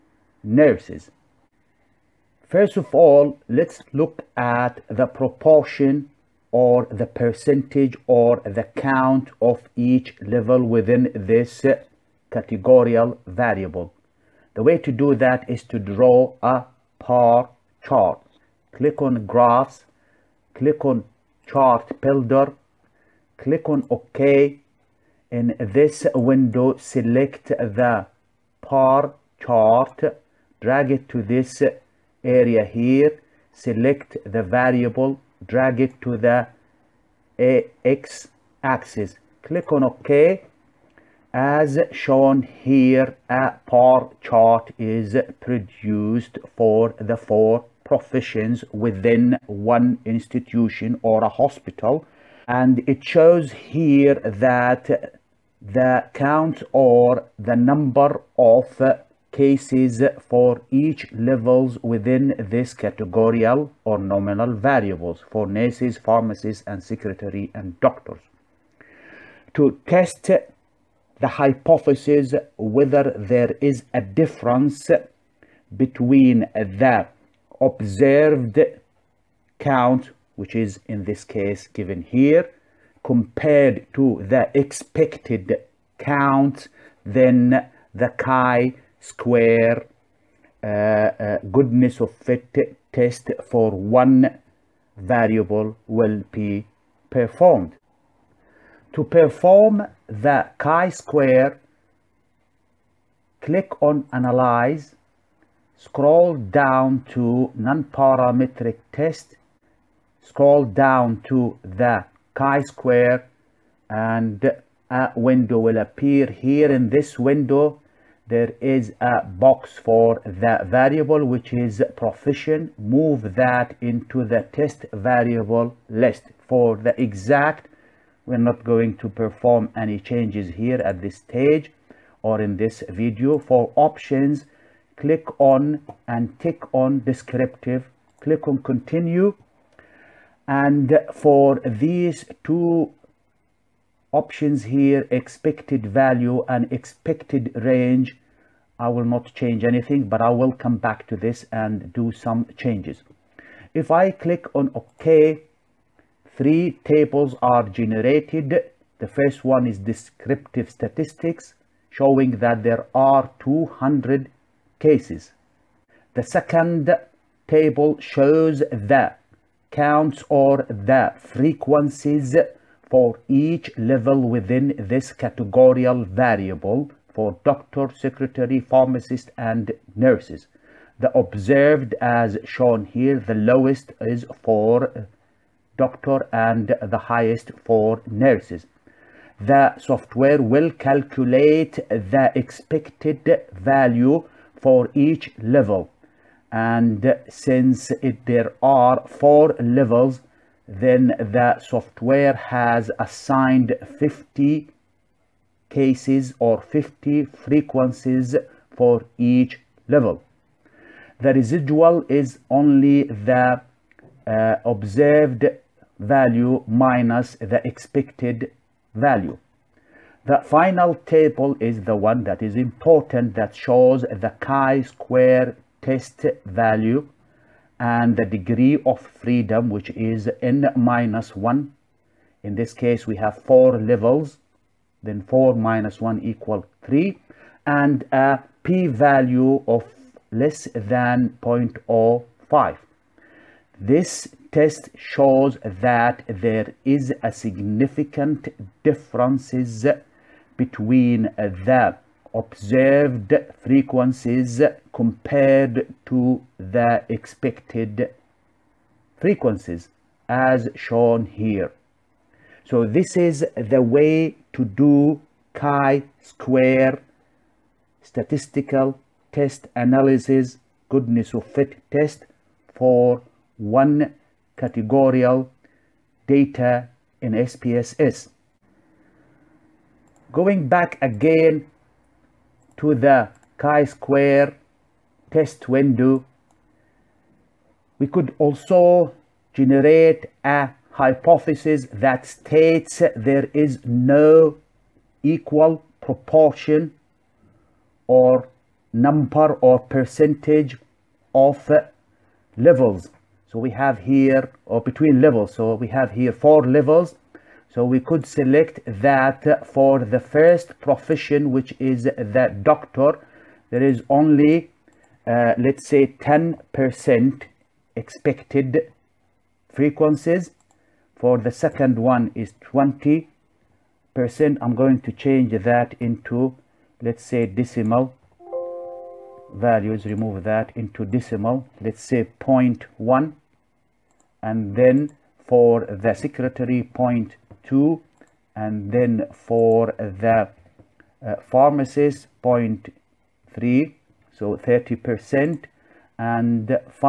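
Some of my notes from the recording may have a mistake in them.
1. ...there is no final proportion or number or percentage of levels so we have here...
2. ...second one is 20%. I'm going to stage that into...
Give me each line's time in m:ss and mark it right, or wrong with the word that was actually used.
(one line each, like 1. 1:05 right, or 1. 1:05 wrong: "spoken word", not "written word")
1. 4:53 wrong: "equal", not "final"
2. 5:21 wrong: "change", not "stage".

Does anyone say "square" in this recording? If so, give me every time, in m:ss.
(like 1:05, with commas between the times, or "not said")
1:28, 1:40, 1:52, 3:44, 4:25, 4:43.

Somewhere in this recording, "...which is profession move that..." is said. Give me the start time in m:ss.
2:01.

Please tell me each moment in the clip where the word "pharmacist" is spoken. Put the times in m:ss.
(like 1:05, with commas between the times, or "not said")
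1:05, 2:58, 5:41.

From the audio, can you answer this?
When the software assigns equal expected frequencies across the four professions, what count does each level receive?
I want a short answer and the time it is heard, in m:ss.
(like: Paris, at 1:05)
50, at 3:23.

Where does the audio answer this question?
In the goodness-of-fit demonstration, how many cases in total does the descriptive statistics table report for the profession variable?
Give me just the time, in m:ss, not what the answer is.
2:43.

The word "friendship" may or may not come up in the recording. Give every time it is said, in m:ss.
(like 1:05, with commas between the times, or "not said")
not said.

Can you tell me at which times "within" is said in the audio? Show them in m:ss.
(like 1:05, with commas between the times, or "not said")
0:10, 0:48, 1:01, 2:54.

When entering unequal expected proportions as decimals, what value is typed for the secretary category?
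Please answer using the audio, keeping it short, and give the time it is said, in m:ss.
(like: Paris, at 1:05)
0.2, at 5:36.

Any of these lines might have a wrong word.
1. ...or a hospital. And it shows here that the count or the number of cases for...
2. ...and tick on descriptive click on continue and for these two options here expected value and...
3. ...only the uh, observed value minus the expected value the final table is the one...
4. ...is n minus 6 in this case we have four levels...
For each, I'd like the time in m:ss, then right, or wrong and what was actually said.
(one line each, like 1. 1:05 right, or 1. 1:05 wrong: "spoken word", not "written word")
1. 0:51 right
2. 2:16 right
3. 3:32 right
4. 3:49 wrong: "1", not "6".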